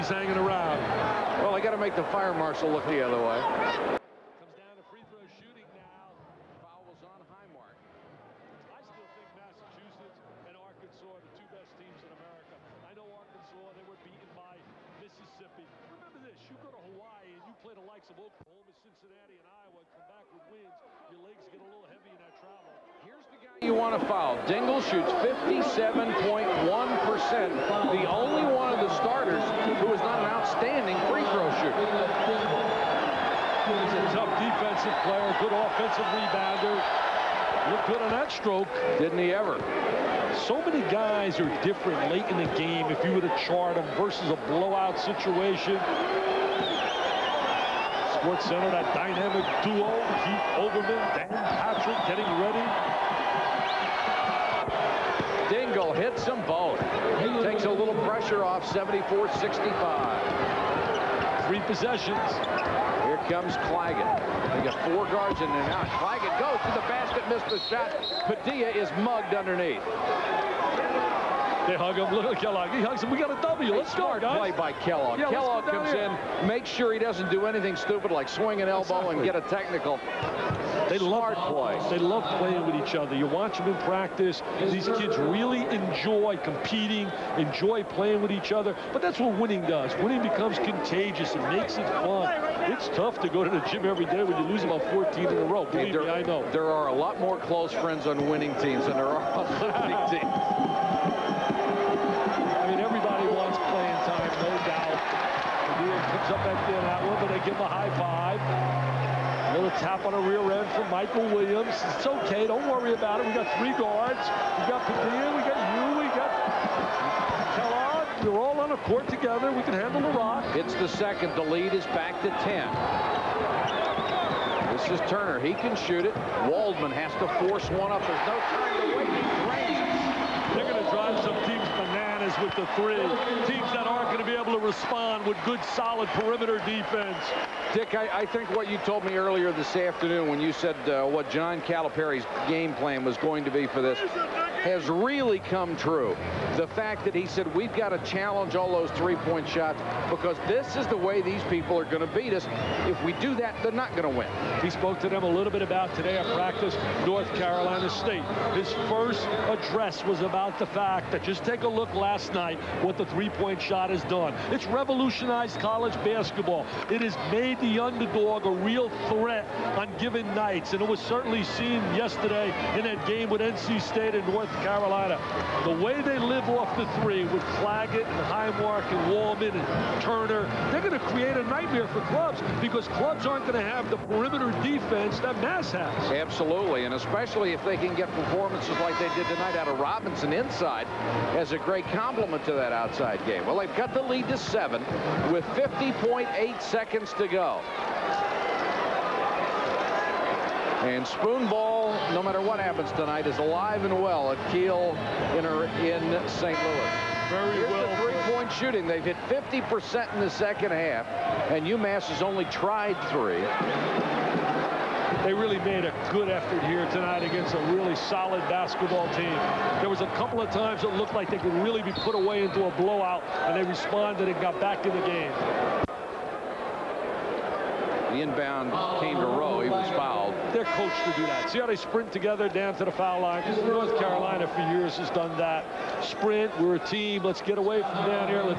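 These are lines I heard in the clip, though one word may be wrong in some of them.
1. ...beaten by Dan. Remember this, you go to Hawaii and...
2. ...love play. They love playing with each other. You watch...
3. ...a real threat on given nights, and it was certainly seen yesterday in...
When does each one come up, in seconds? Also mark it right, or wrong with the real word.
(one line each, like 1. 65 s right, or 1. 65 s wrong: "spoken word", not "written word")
1. 14 s wrong: "Mississippi", not "Dan"
2. 80 s right
3. 168 s right.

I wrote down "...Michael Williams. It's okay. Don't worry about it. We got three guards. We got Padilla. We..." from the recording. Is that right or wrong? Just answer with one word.
right.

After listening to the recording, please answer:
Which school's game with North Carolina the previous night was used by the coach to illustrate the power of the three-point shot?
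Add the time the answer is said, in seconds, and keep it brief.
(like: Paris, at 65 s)
North Carolina State, at 157 s.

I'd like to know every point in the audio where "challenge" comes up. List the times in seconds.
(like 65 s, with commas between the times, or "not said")
147 s.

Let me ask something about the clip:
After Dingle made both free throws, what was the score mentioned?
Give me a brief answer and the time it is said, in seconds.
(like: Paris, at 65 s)
74-65, at 58 s.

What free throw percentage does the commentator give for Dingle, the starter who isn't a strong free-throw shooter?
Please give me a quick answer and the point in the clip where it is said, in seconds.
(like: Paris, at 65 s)
57.1%, at 25 s.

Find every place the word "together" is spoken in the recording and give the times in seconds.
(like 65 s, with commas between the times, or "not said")
119 s, 232 s.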